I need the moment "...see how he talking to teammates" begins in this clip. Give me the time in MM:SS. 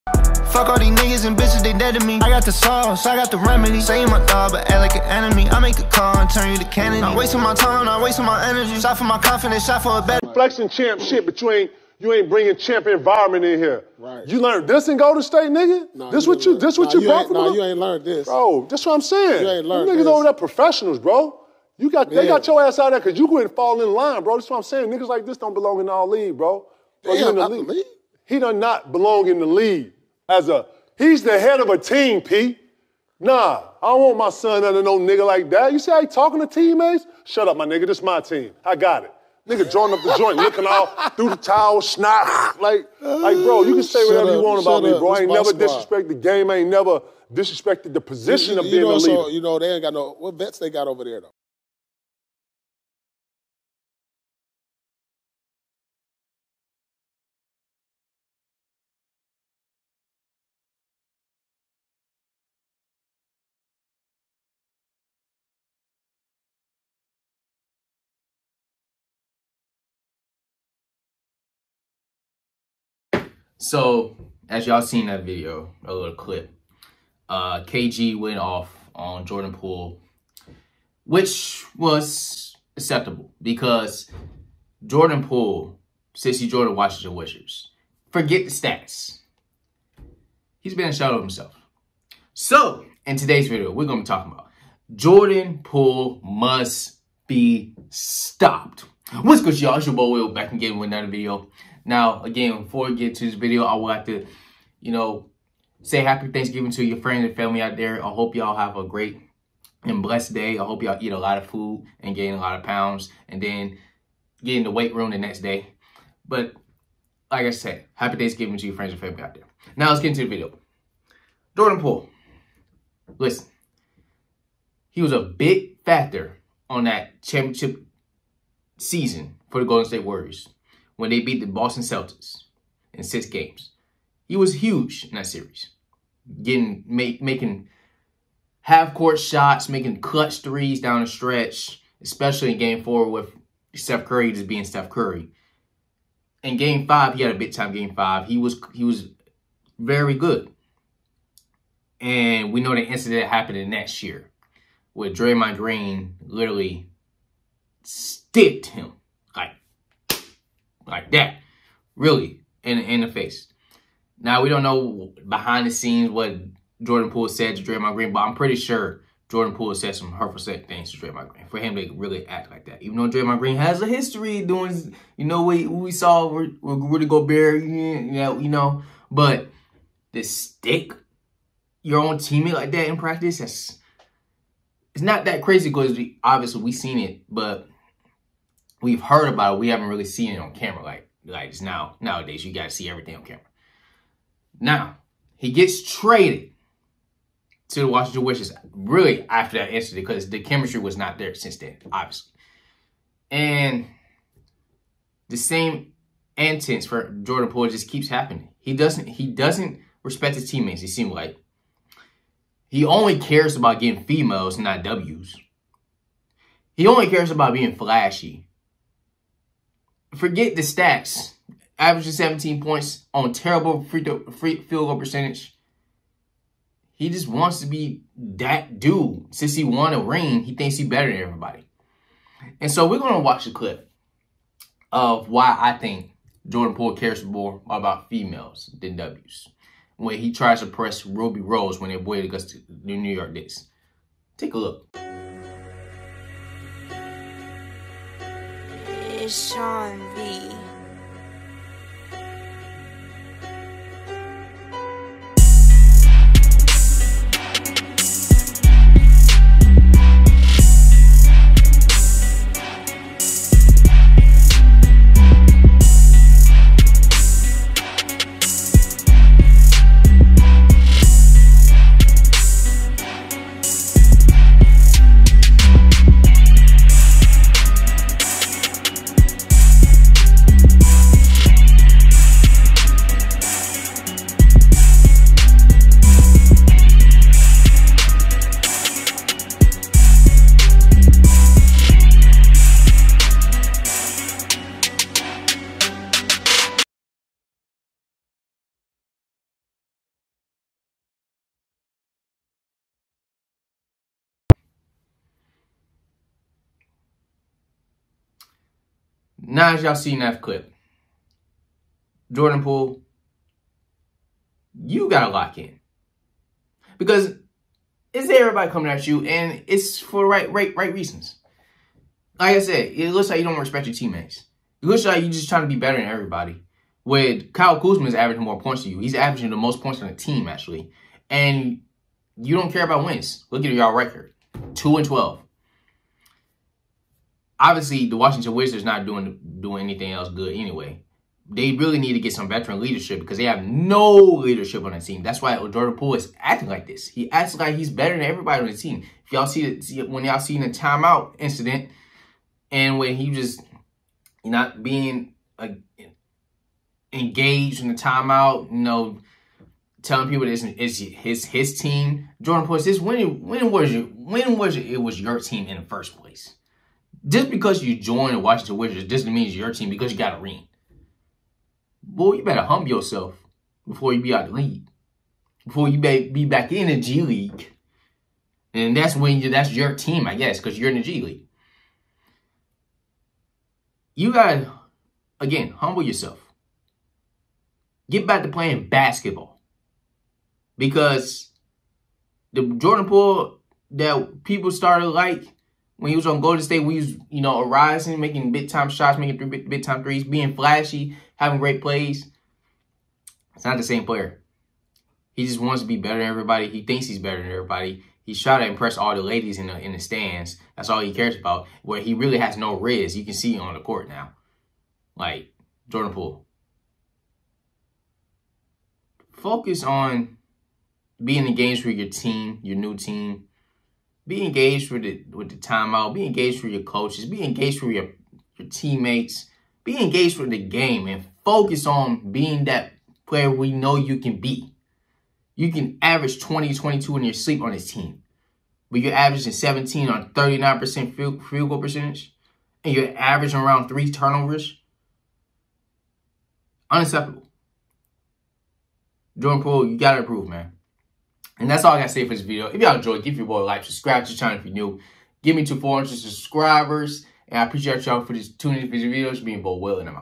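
00:35.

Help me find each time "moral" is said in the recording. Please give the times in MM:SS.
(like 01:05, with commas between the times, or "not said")
not said.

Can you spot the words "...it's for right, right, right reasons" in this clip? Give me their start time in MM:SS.
05:19.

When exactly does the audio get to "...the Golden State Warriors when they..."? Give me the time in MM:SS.
02:09.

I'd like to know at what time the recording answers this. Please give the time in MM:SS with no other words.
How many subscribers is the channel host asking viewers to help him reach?
07:35.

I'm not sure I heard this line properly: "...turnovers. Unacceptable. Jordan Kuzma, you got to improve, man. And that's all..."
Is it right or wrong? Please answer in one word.
wrong.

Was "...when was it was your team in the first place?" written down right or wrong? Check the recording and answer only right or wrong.
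right.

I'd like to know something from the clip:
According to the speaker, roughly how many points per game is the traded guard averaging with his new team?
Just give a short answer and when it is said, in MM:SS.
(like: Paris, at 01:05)
17, at 03:42.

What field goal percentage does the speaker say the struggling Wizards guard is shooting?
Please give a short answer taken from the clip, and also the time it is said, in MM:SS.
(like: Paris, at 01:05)
39%, at 07:20.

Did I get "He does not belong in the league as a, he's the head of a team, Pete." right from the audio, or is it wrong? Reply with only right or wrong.
right.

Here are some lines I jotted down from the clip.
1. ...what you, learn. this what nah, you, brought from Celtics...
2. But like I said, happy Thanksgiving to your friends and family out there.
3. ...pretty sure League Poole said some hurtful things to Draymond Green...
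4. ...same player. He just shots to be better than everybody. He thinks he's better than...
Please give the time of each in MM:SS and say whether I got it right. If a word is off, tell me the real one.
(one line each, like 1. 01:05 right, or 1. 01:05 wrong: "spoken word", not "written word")
1. 00:16 wrong: "Nah", not "Celtics"
2. 01:56 right
3. 02:48 wrong: "Jordan", not "League"
4. 06:43 wrong: "wants", not "shots".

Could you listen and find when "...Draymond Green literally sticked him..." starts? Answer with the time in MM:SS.
02:35.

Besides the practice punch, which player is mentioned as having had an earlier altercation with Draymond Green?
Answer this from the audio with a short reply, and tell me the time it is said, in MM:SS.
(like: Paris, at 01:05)
Rudy Gobert, at 02:56.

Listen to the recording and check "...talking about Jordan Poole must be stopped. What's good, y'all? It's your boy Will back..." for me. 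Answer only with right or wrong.
right.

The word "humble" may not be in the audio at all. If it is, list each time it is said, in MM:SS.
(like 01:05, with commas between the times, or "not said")
06:12, 06:25.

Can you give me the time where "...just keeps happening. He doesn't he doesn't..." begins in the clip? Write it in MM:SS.
03:27.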